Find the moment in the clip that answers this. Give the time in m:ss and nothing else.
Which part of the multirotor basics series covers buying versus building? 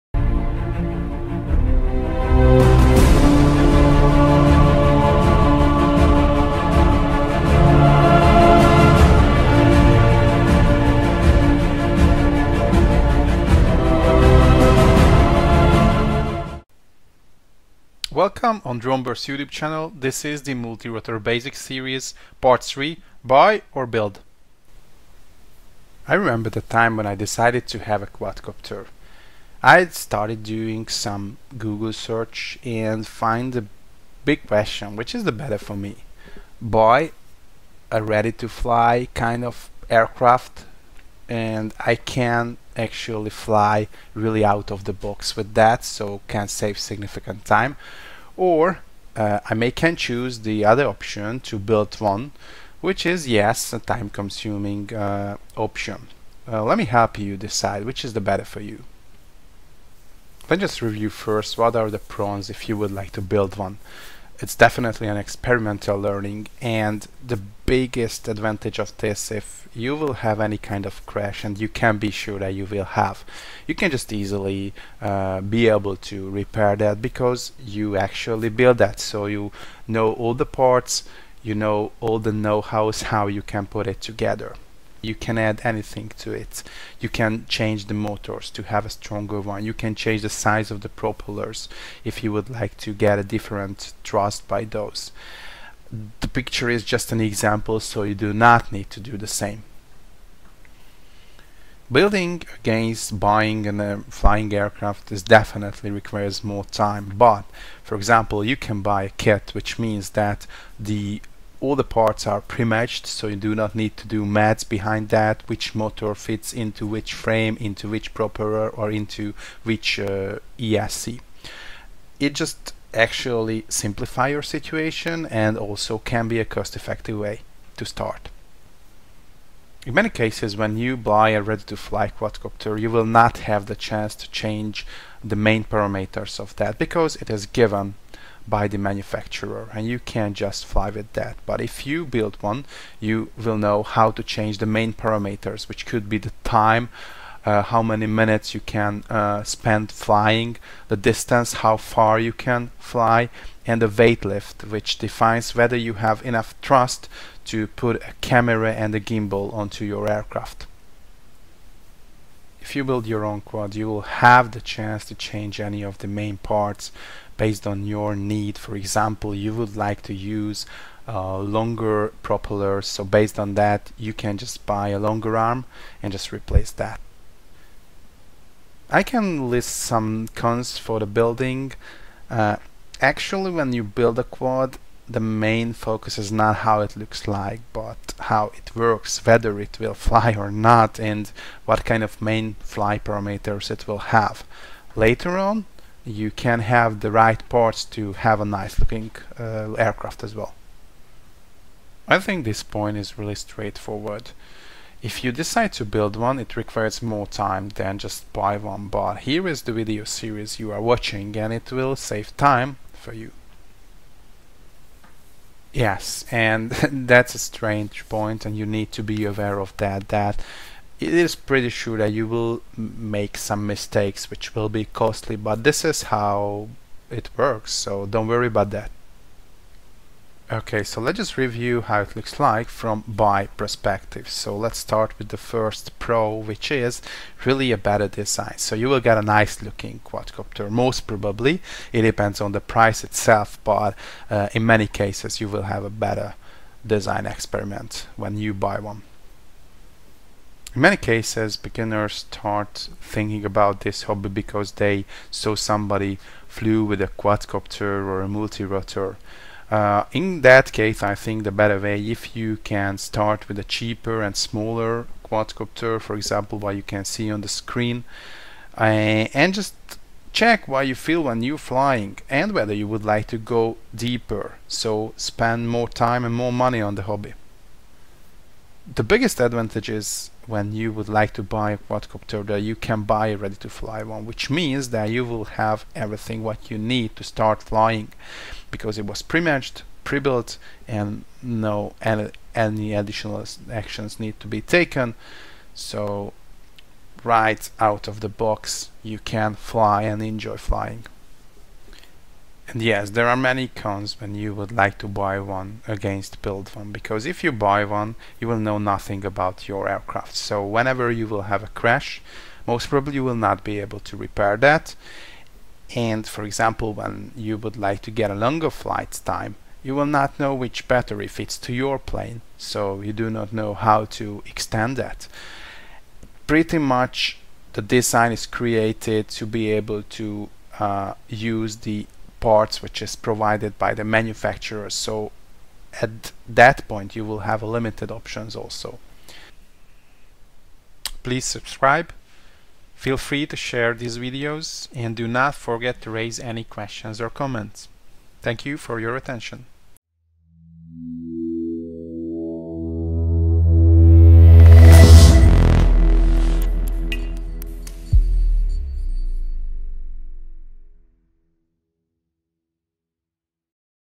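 0:22.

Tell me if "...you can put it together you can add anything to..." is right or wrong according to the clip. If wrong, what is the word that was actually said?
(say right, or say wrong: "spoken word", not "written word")
right.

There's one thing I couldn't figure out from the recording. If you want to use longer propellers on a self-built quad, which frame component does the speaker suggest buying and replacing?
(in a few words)
a longer arm.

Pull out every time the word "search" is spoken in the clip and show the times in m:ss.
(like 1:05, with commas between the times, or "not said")
0:31.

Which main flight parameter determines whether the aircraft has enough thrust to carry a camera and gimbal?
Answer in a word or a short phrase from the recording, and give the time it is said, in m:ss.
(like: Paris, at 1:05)
weight lift, at 2:33.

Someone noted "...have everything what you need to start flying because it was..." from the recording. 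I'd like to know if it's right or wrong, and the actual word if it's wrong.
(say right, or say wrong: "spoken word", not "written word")
right.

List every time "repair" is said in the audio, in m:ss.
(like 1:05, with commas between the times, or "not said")
1:16, 5:14.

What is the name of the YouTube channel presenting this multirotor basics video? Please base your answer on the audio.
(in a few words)
Droneburst.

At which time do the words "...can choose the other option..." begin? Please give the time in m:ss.
0:49.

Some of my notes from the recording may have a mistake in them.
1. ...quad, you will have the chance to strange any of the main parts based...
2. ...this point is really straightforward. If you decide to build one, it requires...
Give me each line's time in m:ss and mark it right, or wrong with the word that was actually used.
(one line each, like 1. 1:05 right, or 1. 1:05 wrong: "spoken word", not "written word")
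1. 2:43 wrong: "change", not "strange"
2. 3:22 right.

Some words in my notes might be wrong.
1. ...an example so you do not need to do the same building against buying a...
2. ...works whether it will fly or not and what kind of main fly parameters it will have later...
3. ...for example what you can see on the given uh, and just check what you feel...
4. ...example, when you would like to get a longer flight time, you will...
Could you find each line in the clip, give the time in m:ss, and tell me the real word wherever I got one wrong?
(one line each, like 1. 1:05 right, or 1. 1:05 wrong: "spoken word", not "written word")
1. 1:37 right
2. 3:08 right
3. 4:25 wrong: "screen", not "given"
4. 5:16 right.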